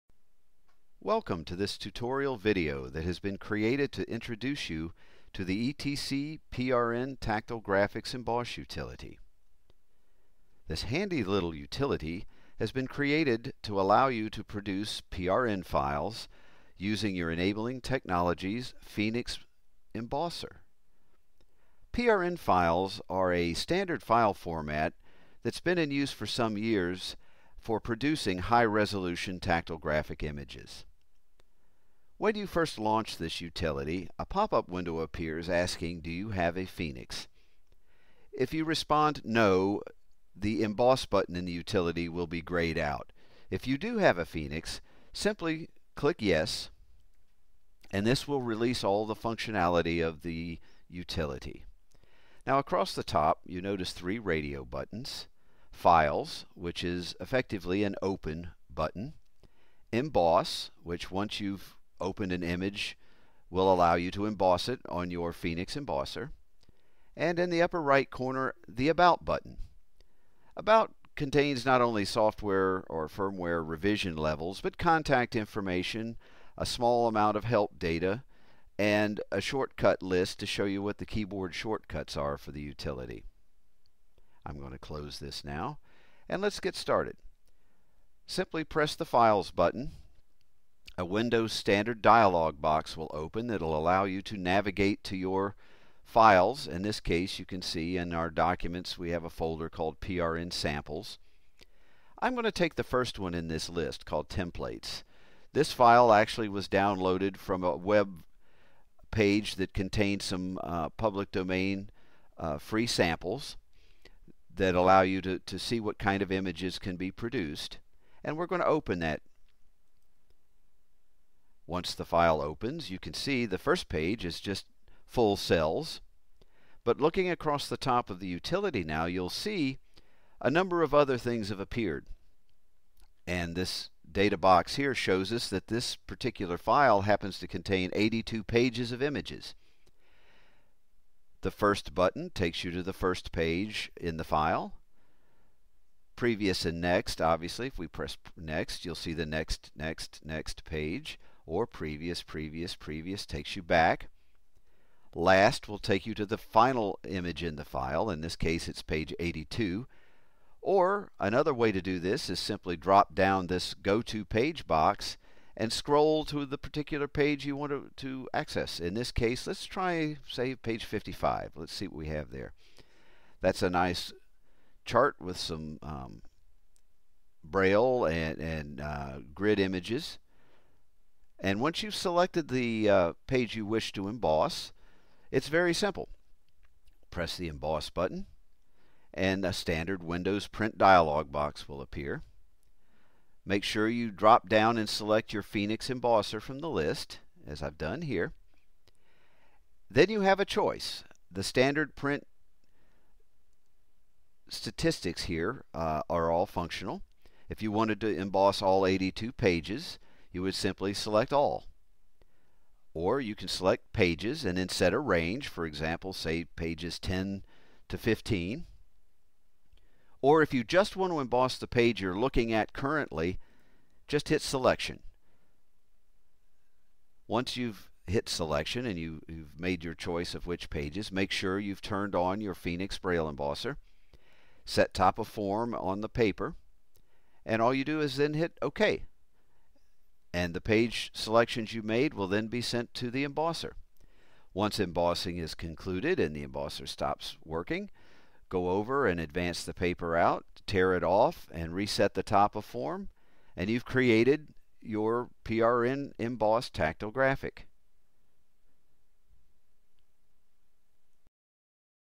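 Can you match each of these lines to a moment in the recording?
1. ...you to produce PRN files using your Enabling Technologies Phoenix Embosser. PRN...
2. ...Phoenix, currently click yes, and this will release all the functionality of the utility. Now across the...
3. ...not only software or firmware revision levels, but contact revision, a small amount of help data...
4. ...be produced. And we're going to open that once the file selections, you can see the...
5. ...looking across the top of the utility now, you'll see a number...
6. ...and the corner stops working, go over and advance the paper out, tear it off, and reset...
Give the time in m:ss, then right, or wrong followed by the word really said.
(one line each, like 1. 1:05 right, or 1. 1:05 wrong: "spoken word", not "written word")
1. 0:14 right
2. 0:44 wrong: "simply", not "currently"
3. 1:11 wrong: "information", not "revision"
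4. 1:56 wrong: "opens", not "selections"
5. 2:06 right
6. 4:06 wrong: "embosser", not "corner".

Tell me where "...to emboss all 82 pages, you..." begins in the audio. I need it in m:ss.
3:28.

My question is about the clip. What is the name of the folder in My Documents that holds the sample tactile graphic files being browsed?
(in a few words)
PRN samples.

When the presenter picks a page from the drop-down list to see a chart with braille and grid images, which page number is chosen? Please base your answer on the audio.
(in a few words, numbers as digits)
55.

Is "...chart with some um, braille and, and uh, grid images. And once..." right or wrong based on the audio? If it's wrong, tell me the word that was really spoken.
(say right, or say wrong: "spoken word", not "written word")
right.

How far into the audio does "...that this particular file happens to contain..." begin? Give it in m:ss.
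2:15.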